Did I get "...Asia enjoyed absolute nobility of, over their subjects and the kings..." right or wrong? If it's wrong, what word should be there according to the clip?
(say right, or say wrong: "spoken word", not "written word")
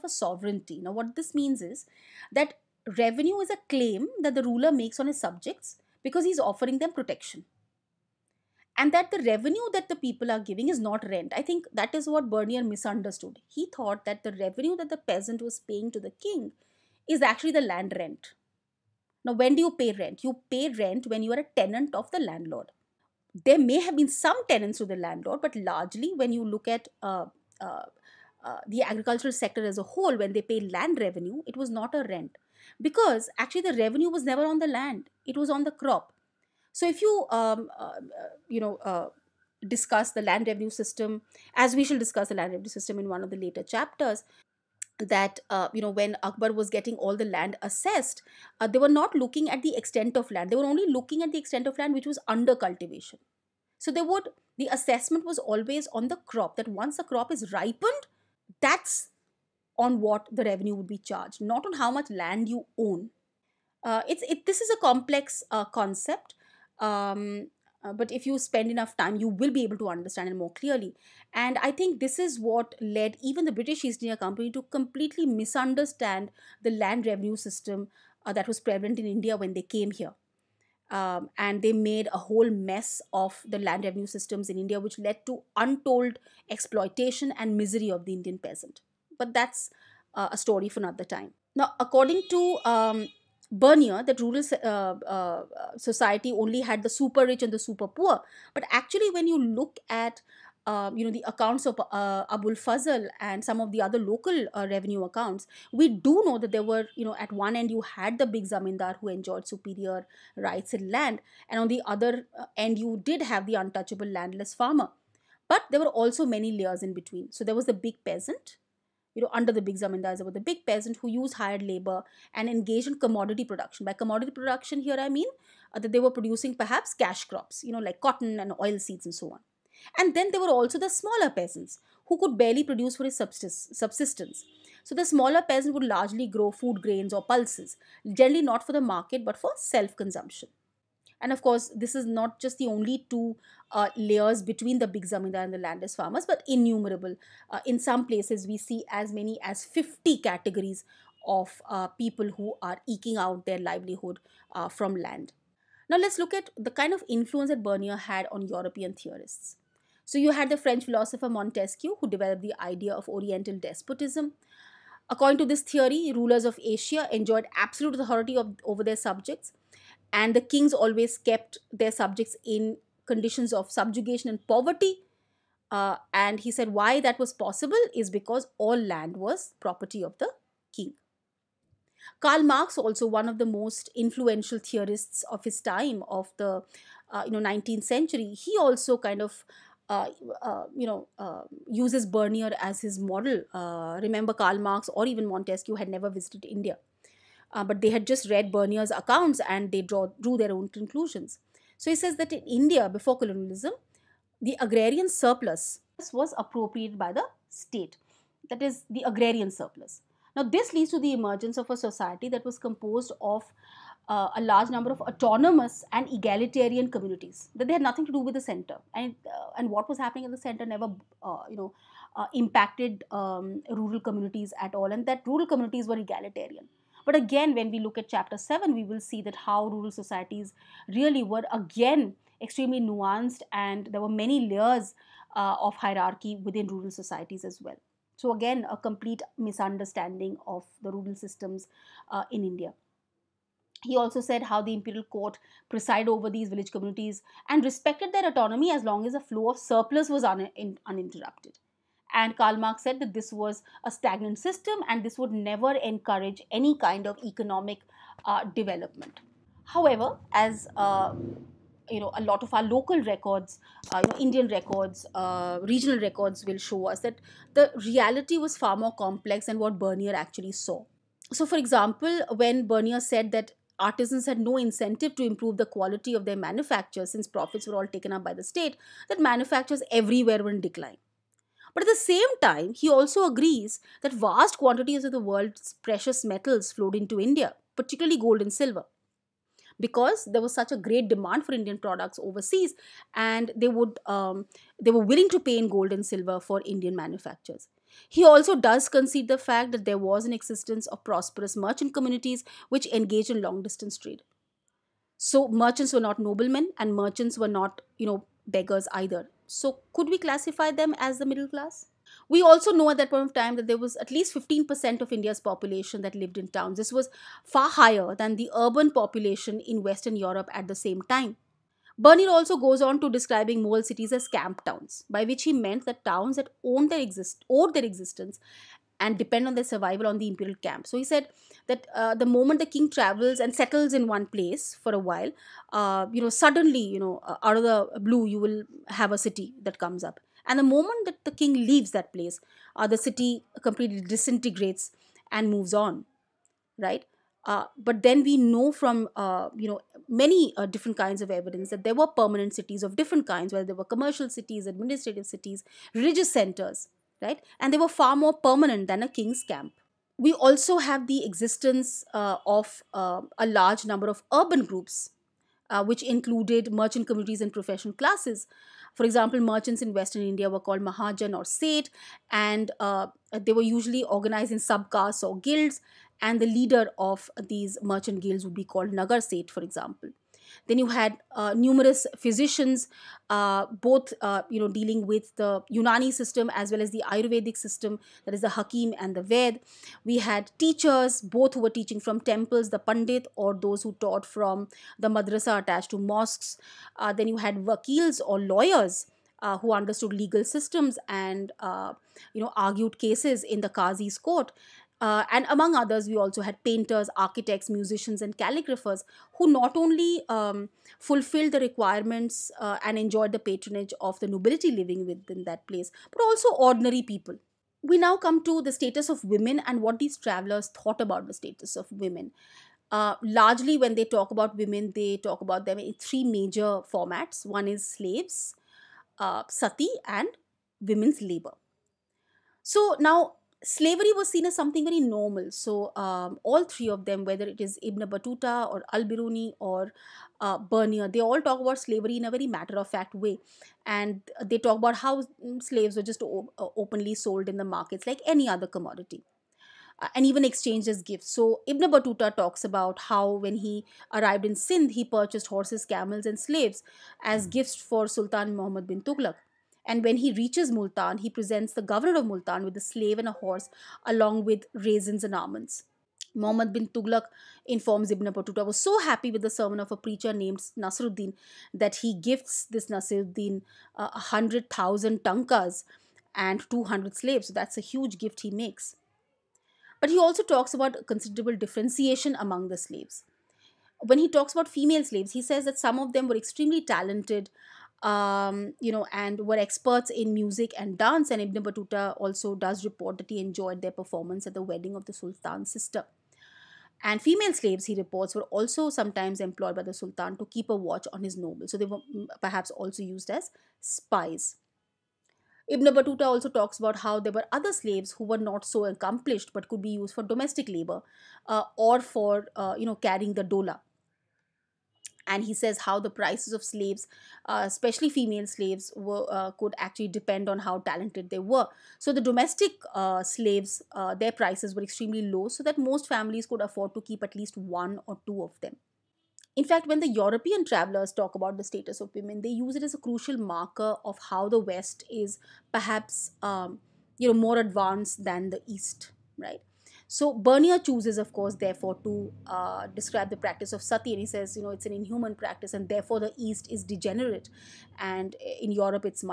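wrong: "authority", not "nobility".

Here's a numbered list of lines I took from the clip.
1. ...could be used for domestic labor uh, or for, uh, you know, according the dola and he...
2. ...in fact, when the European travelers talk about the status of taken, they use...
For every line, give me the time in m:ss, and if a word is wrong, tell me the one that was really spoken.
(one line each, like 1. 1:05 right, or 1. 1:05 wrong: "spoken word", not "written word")
1. 8:29 wrong: "carrying", not "according"
2. 8:49 wrong: "women", not "taken".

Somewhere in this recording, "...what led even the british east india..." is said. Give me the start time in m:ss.
1:12.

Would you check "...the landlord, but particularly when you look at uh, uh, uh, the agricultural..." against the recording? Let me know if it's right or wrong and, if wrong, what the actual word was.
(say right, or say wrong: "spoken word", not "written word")
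wrong: "largely", not "particularly".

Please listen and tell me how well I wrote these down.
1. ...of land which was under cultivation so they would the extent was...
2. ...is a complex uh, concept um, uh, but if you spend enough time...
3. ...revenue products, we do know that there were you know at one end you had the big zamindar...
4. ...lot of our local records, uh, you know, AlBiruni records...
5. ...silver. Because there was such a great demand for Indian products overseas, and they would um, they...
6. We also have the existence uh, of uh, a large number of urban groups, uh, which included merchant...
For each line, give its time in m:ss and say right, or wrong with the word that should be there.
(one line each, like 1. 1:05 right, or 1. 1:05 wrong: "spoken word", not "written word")
1. 0:51 wrong: "assessment", not "extent"
2. 1:04 right
3. 1:44 wrong: "accounts", not "products"
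4. 4:22 wrong: "Indian", not "AlBiruni"
5. 4:48 right
6. 6:00 right.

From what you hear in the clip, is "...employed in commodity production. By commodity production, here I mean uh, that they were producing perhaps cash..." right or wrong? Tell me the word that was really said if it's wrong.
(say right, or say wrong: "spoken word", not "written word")
wrong: "engaged", not "employed".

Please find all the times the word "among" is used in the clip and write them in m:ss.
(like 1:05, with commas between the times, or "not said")
6:45, 8:02.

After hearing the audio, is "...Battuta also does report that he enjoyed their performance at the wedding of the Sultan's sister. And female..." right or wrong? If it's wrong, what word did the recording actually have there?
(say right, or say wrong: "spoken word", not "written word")
right.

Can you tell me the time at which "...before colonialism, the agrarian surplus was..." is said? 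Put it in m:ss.
3:22.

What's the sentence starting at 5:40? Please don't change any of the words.
And the moment that the king leaves that place, uh, the city completely disintegrates and moves on, right?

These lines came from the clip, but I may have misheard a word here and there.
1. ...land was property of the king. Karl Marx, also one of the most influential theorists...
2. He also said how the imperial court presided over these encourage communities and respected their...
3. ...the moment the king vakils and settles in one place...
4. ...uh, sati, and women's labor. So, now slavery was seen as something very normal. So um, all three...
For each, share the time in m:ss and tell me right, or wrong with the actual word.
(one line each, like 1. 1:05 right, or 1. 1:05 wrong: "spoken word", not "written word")
1. 2:58 right
2. 4:03 wrong: "village", not "encourage"
3. 5:32 wrong: "travels", not "vakils"
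4. 7:09 right.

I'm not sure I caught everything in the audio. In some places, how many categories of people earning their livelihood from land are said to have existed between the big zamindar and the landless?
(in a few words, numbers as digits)
50.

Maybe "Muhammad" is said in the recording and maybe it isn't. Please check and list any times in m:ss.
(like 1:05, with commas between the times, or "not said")
7:38, 7:46.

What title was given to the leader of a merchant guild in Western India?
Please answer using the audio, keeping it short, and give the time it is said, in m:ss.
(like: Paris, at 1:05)
Nagar Seth, at 6:18.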